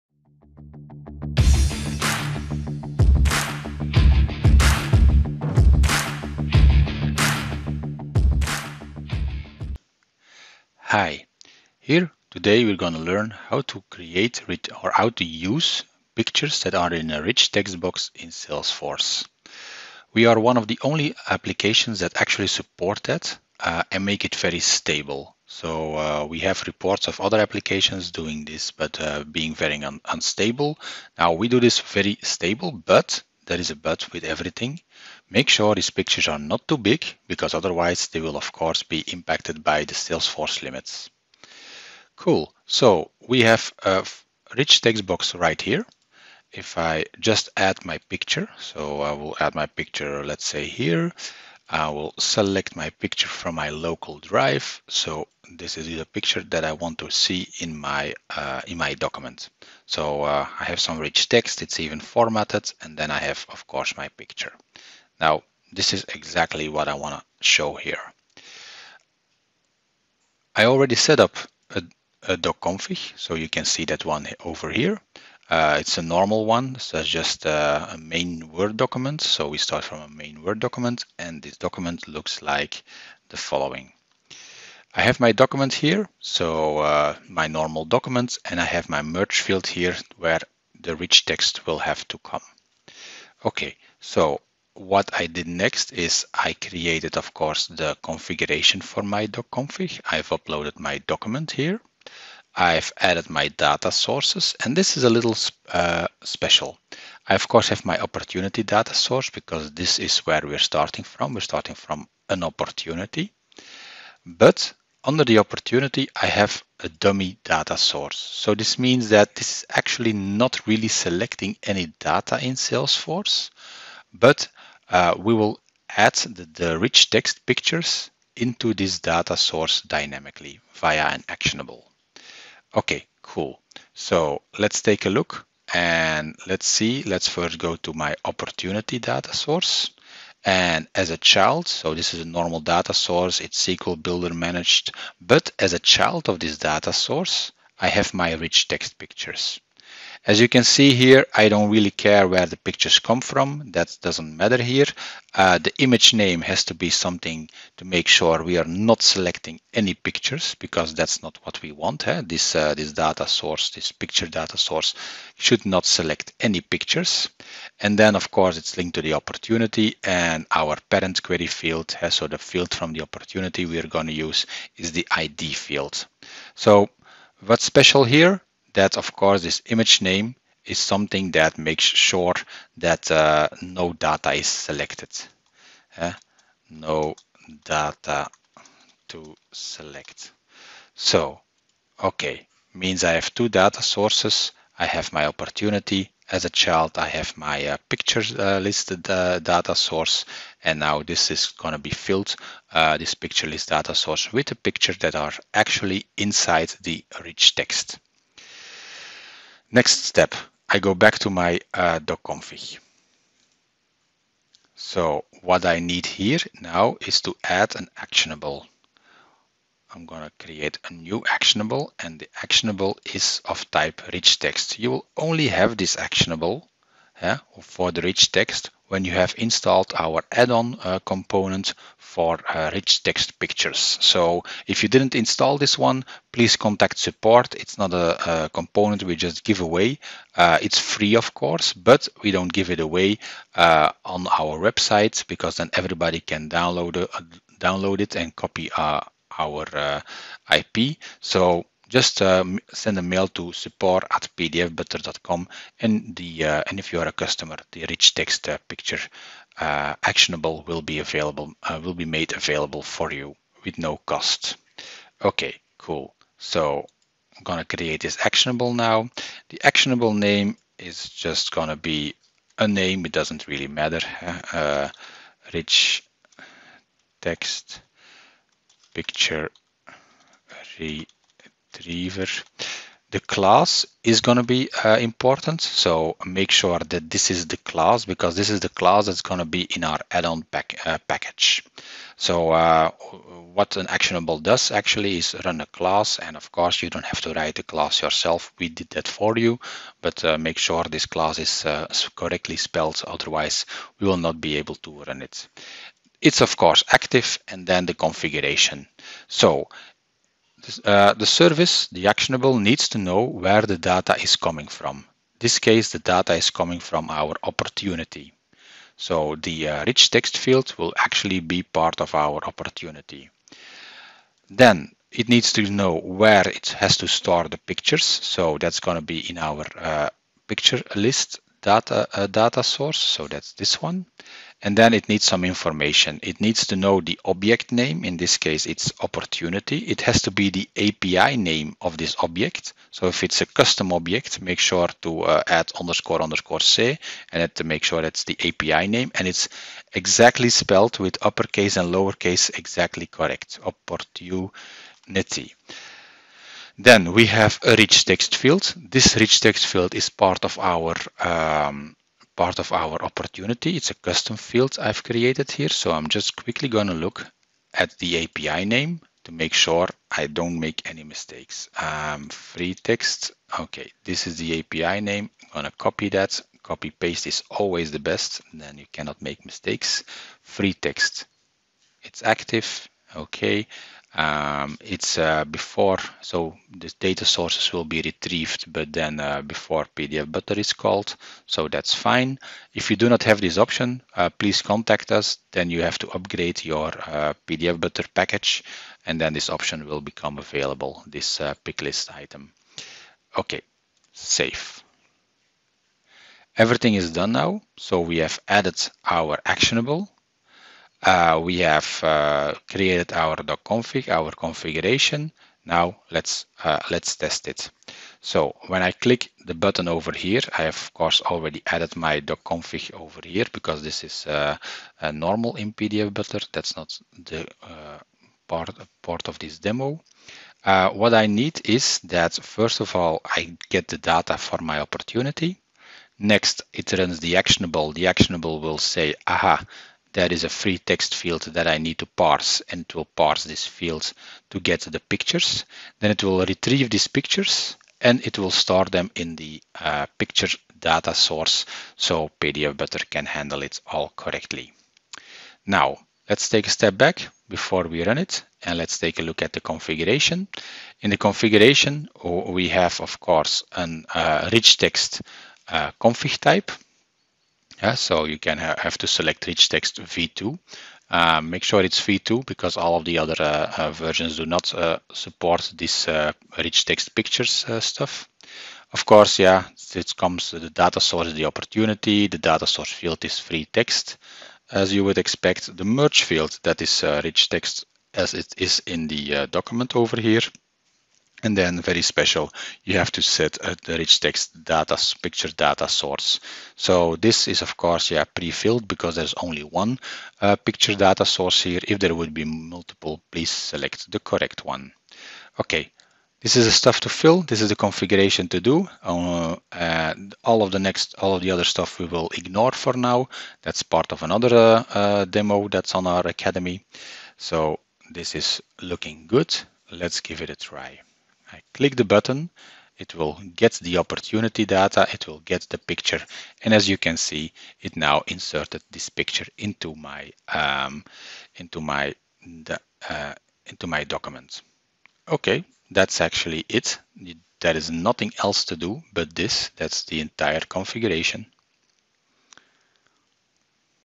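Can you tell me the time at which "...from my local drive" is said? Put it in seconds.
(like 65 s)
53 s.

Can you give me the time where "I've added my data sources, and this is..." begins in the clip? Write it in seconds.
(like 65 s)
102 s.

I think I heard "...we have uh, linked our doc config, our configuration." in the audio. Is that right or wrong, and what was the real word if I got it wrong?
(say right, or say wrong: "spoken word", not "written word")
wrong: "created", not "linked".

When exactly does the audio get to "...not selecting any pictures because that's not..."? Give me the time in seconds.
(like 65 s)
158 s.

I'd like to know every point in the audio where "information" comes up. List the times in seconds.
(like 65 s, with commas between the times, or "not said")
335 s.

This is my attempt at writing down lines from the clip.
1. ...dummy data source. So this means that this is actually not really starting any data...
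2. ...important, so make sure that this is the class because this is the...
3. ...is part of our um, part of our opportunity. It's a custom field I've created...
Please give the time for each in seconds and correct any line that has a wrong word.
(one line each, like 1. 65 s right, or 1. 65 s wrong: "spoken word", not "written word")
1. 116 s wrong: "selecting", not "starting"
2. 285 s right
3. 359 s right.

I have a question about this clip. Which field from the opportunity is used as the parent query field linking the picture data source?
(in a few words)
ID field.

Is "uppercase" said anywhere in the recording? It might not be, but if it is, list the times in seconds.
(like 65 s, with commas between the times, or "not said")
351 s.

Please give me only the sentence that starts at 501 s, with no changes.
If there would be multiple, please select the correct one.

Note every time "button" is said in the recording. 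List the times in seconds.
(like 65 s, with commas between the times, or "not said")
419 s, 522 s.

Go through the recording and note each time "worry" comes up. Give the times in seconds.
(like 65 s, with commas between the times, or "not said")
not said.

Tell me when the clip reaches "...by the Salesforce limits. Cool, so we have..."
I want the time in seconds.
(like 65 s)
39 s.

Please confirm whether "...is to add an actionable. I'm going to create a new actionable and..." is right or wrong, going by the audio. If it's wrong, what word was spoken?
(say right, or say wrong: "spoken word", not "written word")
right.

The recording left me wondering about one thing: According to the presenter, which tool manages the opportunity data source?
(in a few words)
SQL Builder.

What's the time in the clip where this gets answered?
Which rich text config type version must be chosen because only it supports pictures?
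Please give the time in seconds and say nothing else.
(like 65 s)
469 s.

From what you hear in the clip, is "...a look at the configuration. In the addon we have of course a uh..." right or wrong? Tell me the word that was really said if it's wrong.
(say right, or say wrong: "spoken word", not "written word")
wrong: "configuration", not "addon".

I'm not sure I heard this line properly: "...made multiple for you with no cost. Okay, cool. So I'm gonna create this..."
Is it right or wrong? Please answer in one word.
wrong.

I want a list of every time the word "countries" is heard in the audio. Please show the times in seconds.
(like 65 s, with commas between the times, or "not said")
not said.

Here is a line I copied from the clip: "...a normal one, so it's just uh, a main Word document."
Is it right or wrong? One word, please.
right.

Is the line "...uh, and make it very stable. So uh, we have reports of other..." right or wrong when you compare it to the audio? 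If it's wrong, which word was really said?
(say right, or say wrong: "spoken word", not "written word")
right.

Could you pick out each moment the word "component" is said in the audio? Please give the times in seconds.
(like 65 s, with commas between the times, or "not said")
231 s, 238 s.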